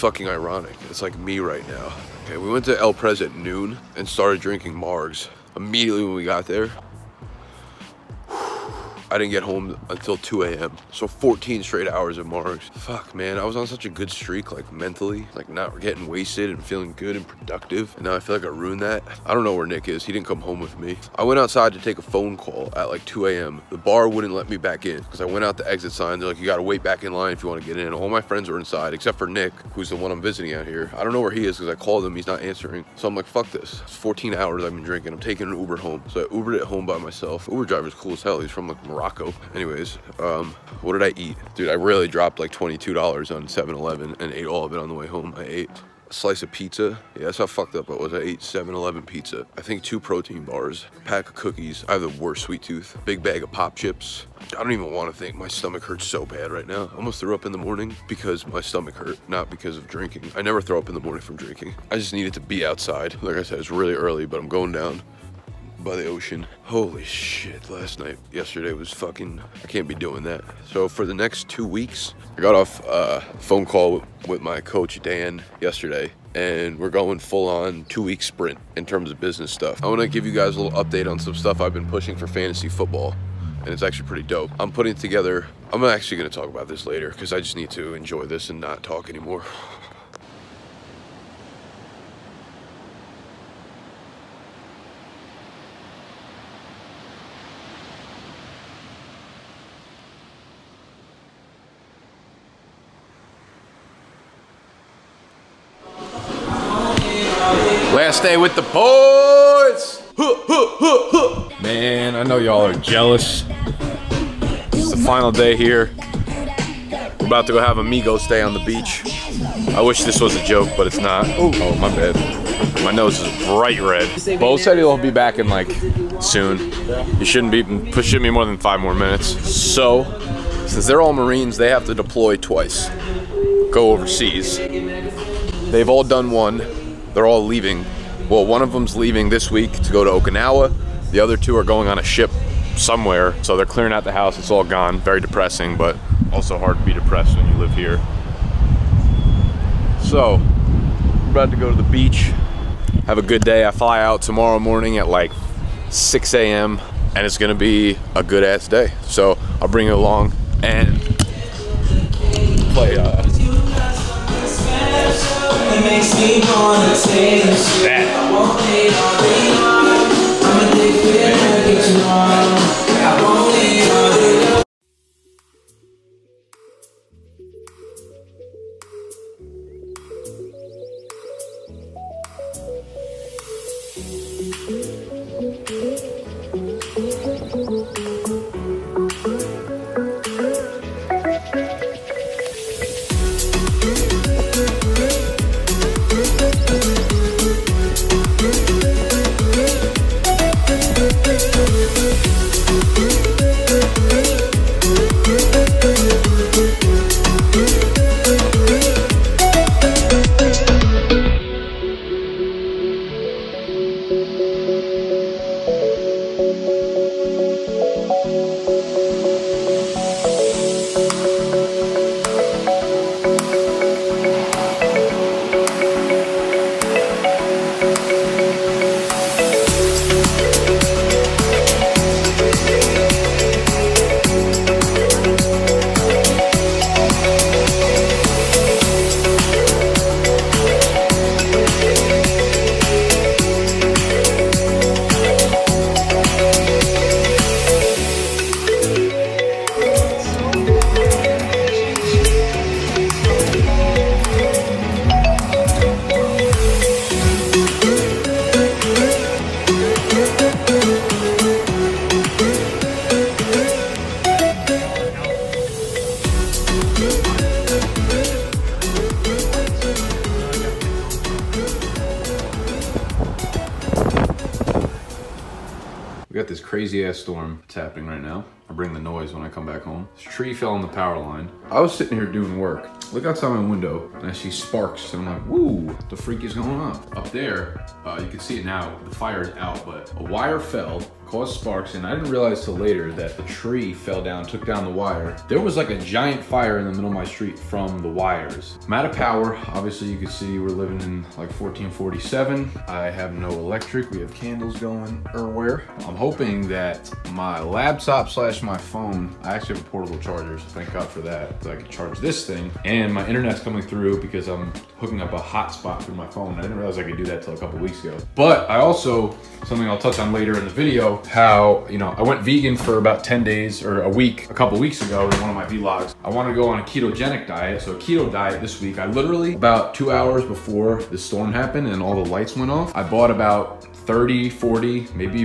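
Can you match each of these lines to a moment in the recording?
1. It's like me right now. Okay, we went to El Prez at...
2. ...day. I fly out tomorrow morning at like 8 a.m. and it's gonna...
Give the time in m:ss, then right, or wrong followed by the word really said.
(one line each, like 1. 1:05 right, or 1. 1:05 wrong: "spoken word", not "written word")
1. 0:00 right
2. 2:33 wrong: "6", not "8".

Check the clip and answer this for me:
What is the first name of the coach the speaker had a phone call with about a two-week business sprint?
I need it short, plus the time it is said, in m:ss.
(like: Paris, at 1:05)
Dan, at 1:15.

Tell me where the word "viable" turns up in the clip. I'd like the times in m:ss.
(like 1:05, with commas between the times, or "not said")
not said.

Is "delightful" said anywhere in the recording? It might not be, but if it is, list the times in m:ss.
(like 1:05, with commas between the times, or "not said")
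not said.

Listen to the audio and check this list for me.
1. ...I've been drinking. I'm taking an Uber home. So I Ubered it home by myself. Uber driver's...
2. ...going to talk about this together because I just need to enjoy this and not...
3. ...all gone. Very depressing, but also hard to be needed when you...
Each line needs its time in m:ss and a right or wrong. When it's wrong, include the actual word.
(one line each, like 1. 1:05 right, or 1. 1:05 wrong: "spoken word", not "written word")
1. 0:34 right
2. 1:26 wrong: "later", not "together"
3. 2:24 wrong: "depressed", not "needed".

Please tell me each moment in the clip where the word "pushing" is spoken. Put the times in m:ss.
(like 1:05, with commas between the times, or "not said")
1:21, 2:07.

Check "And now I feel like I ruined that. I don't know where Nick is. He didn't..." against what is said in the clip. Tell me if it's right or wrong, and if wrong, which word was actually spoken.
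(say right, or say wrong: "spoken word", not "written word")
right.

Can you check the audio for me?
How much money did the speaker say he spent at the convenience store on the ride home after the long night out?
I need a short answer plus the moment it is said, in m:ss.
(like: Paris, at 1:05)
$22, at 0:42.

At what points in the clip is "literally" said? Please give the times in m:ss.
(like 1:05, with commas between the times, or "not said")
5:29.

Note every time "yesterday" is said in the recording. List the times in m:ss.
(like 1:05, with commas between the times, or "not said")
1:08, 1:15.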